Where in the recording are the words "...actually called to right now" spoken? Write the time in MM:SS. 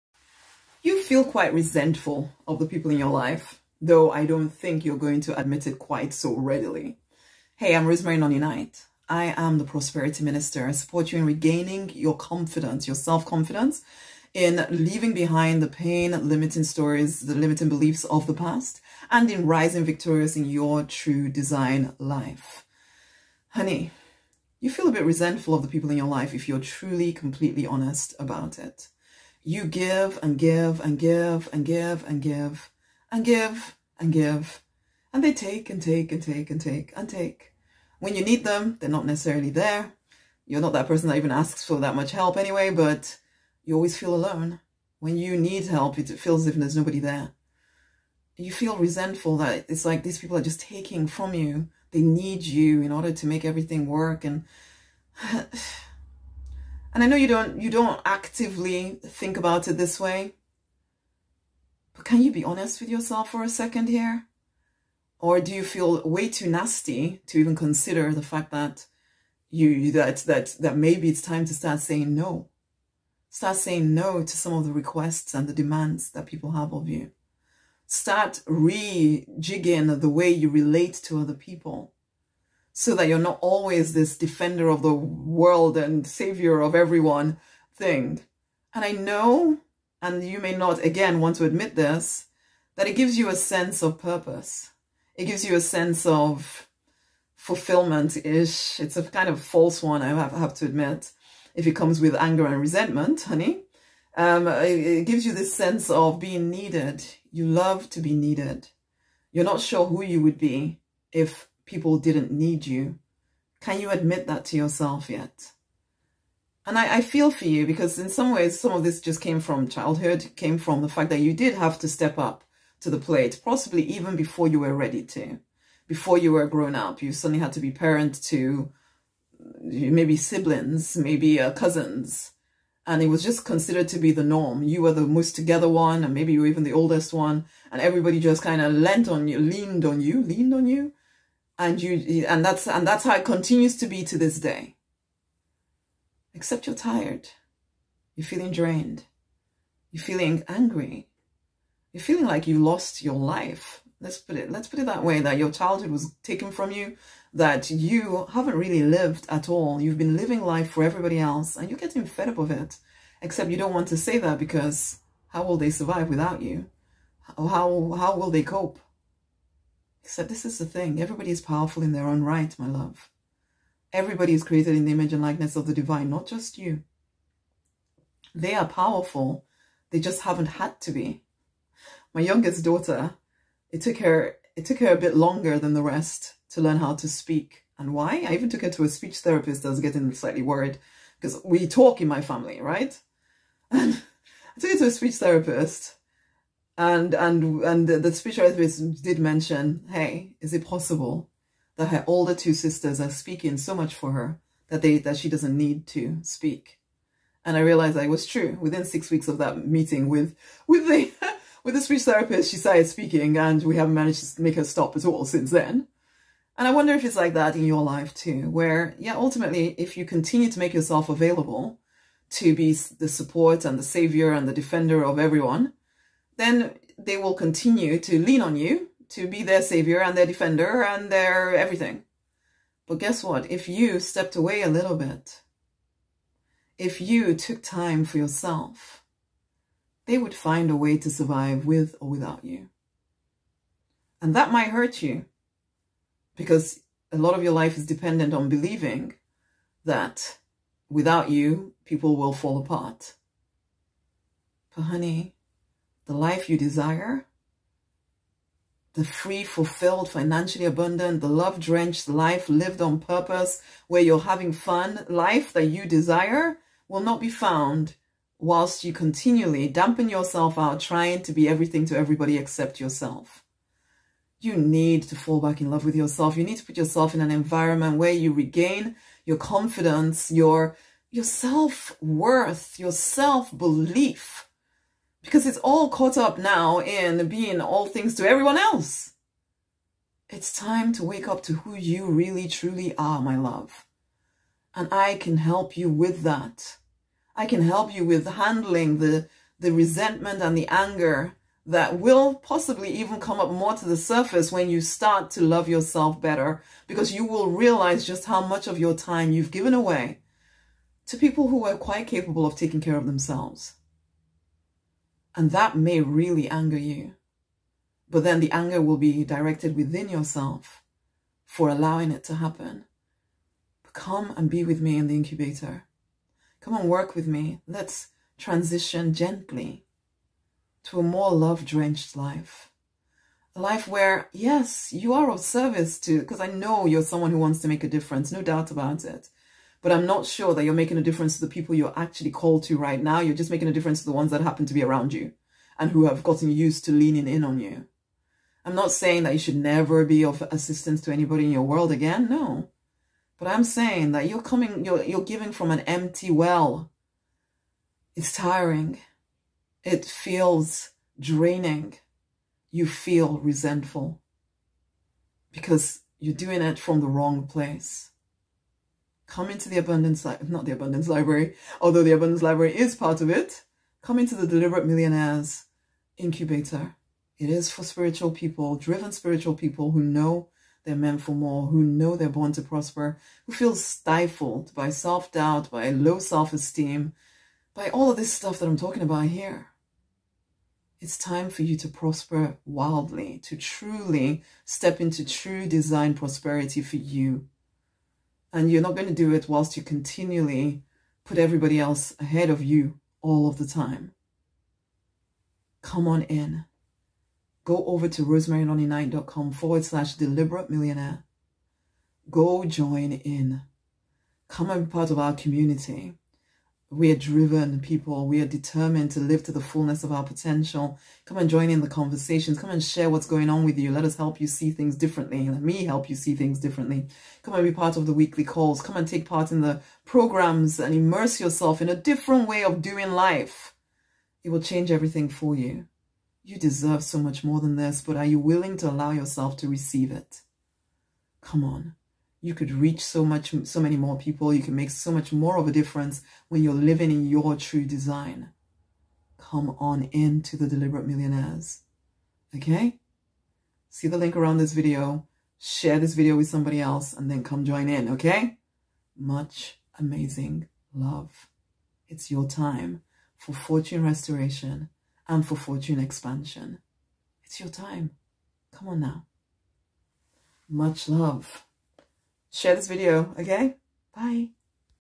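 05:41.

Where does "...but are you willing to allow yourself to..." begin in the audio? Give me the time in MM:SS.
07:18.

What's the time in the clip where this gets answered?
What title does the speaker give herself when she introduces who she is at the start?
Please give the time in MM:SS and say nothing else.
00:09.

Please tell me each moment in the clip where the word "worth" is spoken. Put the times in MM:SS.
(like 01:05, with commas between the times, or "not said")
04:41.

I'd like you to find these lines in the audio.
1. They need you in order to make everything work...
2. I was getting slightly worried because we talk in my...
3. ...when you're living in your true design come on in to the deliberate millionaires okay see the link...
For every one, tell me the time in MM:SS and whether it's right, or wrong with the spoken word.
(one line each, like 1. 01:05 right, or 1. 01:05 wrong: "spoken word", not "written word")
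1. 00:51 right
2. 03:09 right
3. 07:26 right.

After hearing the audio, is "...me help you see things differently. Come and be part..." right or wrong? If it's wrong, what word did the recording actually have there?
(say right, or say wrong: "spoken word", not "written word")
right.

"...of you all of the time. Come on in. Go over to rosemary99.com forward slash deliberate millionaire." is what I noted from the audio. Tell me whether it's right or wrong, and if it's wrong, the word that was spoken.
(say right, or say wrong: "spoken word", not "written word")
right.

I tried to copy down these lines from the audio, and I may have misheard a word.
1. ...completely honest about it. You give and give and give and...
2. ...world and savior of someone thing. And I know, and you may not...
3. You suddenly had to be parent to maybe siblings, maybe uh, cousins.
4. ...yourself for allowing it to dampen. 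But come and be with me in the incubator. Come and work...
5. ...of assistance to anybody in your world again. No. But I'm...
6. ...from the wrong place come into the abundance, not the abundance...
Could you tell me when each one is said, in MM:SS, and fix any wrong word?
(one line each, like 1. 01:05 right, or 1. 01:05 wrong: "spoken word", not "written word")
1. 00:27 right
2. 01:24 wrong: "everyone", not "someone"
3. 02:07 right
4. 05:20 wrong: "happen", not "dampen"
5. 05:50 right
6. 06:06 right.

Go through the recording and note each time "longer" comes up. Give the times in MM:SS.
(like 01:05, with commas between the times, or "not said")
03:05.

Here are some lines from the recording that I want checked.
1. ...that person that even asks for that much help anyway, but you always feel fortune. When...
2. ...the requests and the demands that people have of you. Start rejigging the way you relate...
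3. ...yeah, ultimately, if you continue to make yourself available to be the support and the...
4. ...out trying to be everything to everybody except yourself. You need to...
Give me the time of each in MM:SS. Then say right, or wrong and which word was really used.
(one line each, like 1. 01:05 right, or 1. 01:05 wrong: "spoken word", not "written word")
1. 00:40 wrong: "alone", not "fortune"
2. 01:14 right
3. 03:38 right
4. 04:30 right.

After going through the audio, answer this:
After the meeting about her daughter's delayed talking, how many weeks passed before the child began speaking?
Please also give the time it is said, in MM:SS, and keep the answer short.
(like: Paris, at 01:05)
6 weeks, at 03:28.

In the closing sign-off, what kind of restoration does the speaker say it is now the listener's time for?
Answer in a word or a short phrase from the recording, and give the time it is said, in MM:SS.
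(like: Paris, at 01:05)
fortune restoration, at 07:43.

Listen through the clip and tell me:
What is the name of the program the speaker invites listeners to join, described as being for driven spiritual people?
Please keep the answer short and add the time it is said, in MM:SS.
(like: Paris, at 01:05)
Deliberate Millionaires Incubator, at 06:14.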